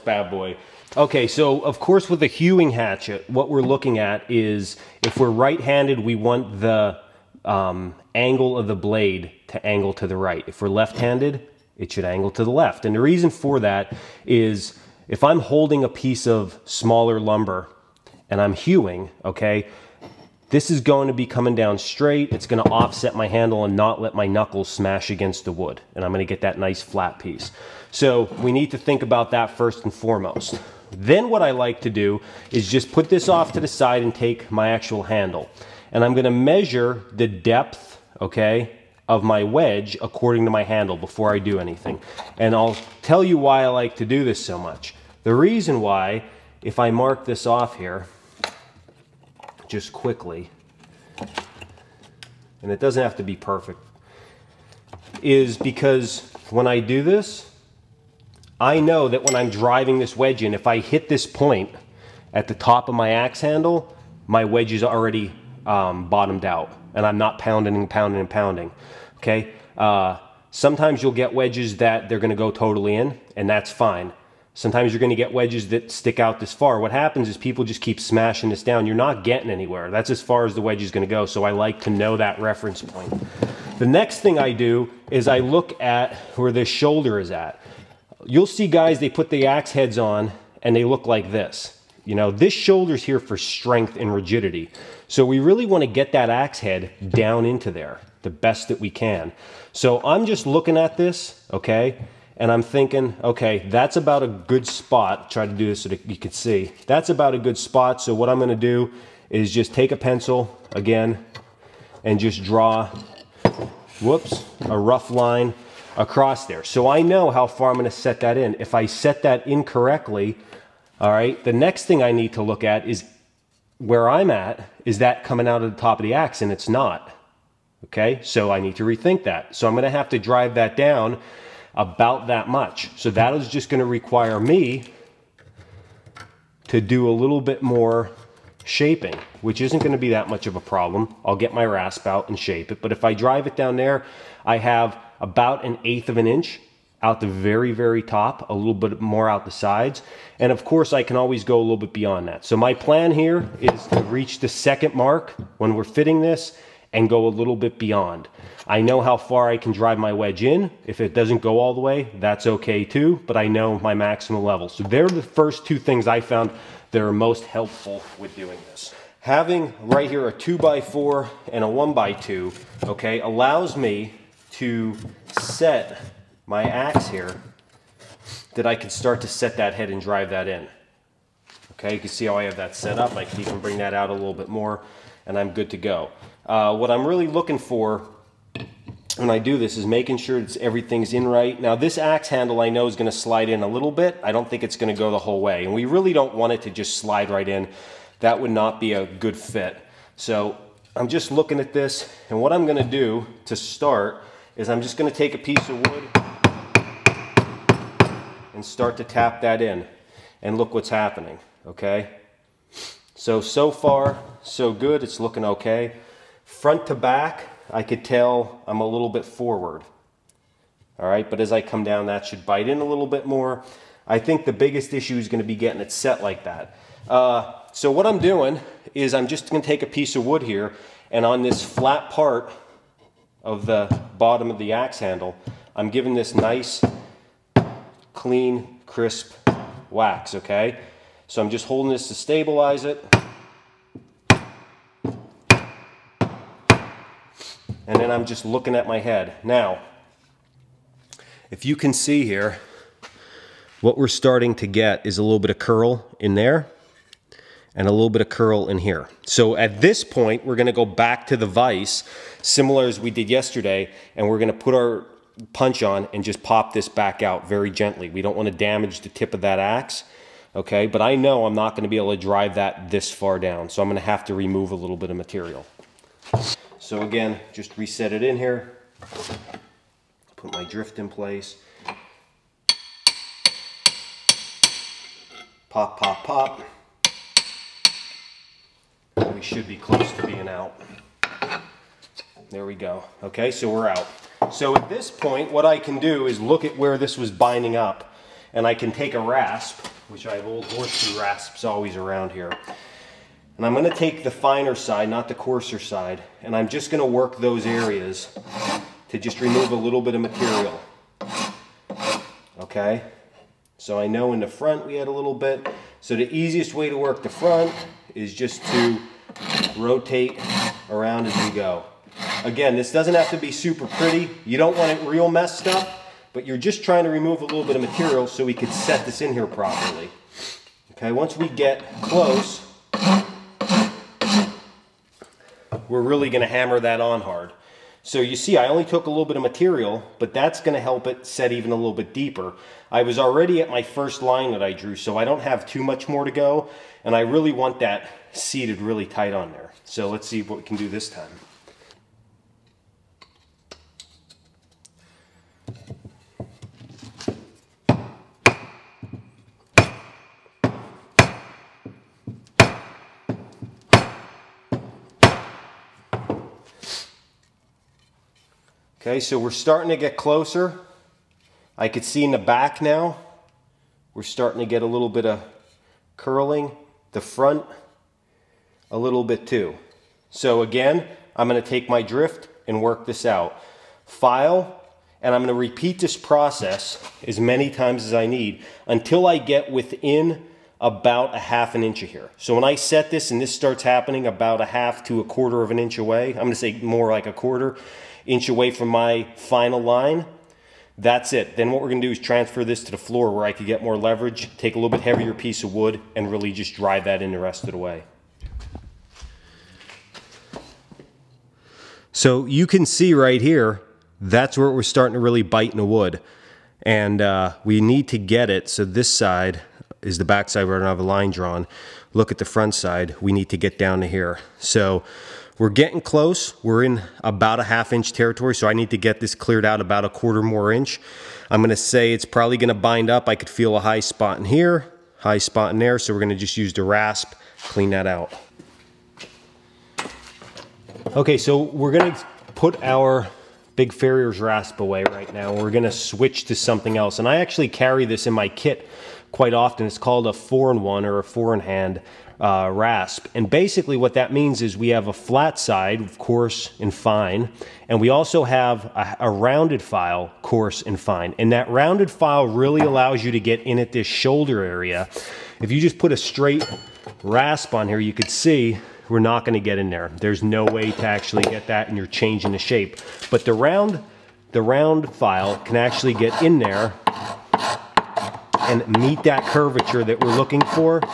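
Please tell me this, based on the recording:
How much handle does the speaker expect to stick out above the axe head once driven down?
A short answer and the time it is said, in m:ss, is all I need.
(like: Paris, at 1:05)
An eighth of an inch, at 2:25.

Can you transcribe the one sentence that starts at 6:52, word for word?
So you can see right here, that's where we're starting to really bite in the wood.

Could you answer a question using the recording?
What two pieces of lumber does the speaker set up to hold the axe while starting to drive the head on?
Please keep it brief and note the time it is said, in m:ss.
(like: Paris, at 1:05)
A 2x4 and a 1x2, at 2:50.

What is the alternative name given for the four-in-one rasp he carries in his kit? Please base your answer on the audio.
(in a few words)
Four-in-hand.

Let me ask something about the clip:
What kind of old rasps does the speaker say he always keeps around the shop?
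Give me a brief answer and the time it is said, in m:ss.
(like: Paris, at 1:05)
Horseshoe rasps, at 5:00.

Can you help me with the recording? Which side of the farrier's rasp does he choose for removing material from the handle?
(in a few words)
The finer side.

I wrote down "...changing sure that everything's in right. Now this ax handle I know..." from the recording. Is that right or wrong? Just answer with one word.
wrong.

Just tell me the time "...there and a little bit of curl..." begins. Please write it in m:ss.
4:16.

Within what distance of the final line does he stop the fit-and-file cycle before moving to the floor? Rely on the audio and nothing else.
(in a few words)
A quarter inch.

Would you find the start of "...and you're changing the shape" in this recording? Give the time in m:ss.
7:51.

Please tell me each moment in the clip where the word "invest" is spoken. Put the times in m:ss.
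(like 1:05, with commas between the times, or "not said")
not said.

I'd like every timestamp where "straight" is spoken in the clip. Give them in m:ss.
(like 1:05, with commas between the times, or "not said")
0:21, 7:46.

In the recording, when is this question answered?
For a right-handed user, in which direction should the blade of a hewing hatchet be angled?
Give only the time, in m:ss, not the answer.
0:09.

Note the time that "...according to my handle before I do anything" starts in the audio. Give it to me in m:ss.
0:40.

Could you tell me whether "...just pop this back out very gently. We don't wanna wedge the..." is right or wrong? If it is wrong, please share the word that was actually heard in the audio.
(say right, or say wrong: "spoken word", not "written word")
wrong: "damage", not "wedge".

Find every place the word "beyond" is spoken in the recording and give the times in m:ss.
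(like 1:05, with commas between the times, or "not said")
2:31, 2:37.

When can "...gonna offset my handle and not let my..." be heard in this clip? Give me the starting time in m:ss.
0:22.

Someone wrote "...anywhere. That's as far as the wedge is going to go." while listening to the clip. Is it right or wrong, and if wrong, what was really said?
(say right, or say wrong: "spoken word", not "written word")
right.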